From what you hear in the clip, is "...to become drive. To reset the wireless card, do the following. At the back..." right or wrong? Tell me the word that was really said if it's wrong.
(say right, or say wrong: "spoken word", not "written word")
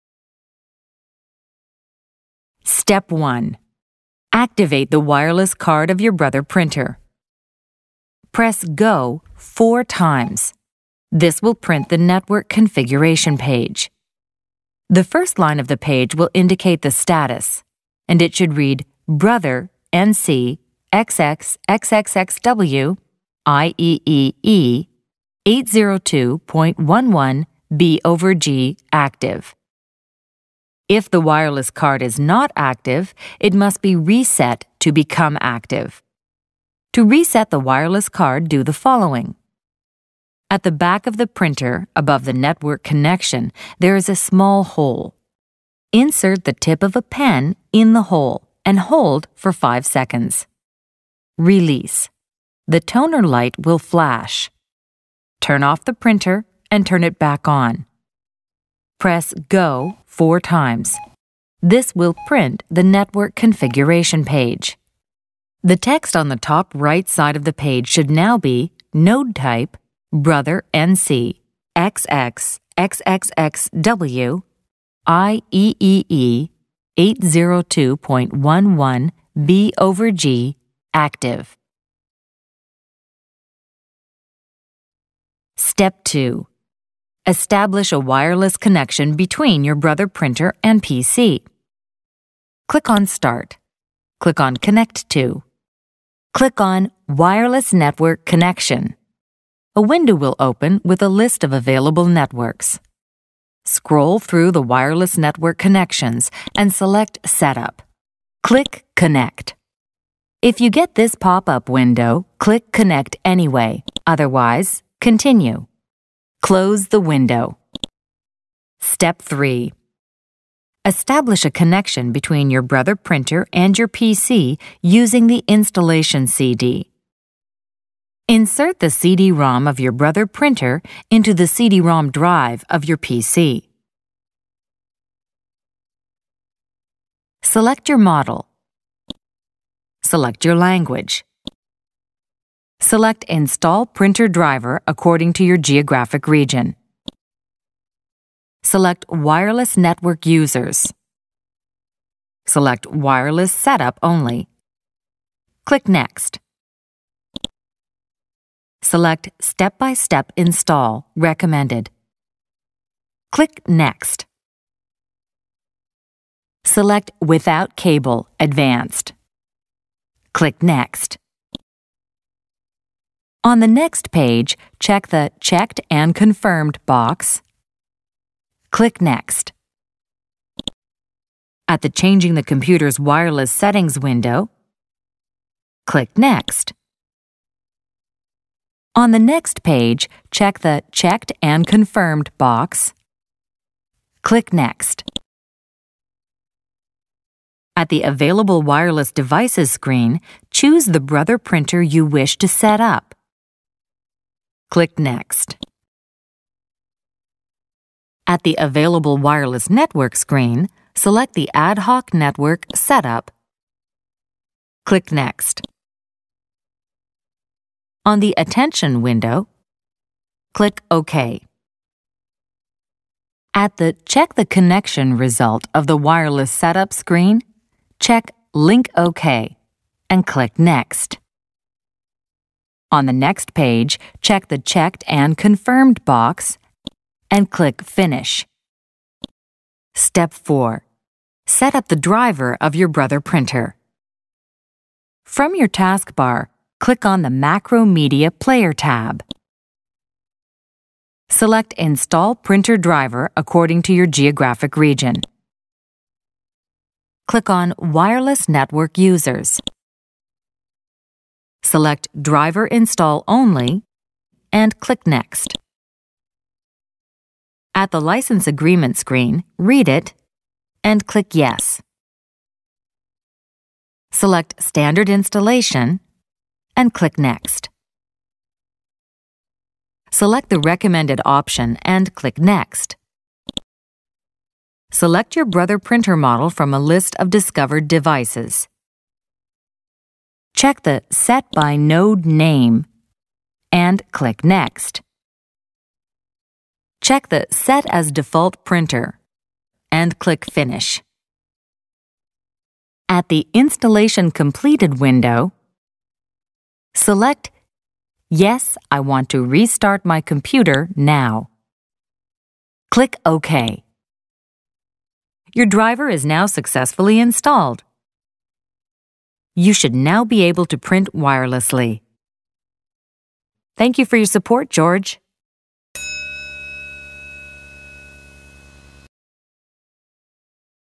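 wrong: "active", not "drive".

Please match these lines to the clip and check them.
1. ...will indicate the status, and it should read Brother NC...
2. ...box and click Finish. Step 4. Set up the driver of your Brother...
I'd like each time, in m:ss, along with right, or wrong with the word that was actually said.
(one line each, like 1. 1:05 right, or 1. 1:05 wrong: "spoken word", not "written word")
1. 0:16 right
2. 3:56 right.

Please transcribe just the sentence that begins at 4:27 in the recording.
At the License Agreement screen, read it, and click Yes.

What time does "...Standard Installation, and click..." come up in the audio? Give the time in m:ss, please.
4:34.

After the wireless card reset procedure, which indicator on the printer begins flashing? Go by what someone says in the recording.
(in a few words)
toner light.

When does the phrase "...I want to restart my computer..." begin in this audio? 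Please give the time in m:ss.
5:08.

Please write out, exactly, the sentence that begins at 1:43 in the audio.
Scroll through the wireless network connections and select Setup.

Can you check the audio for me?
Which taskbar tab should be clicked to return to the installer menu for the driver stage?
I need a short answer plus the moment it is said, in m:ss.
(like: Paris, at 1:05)
Macromedia Player, at 4:07.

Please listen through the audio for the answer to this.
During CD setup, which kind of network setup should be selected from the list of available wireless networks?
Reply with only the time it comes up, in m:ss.
3:31.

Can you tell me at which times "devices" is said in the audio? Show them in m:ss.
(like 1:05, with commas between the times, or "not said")
3:19, 4:47.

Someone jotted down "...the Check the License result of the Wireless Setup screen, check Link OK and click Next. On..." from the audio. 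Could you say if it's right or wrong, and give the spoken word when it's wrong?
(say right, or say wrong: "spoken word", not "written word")
wrong: "Connection", not "License".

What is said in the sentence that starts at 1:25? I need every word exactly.
Step 2 Establish a wireless connection between your Brother printer and PC.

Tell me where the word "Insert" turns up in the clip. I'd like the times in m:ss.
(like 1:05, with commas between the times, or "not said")
0:45, 2:08.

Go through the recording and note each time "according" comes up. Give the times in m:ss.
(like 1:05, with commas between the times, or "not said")
2:24, 4:13.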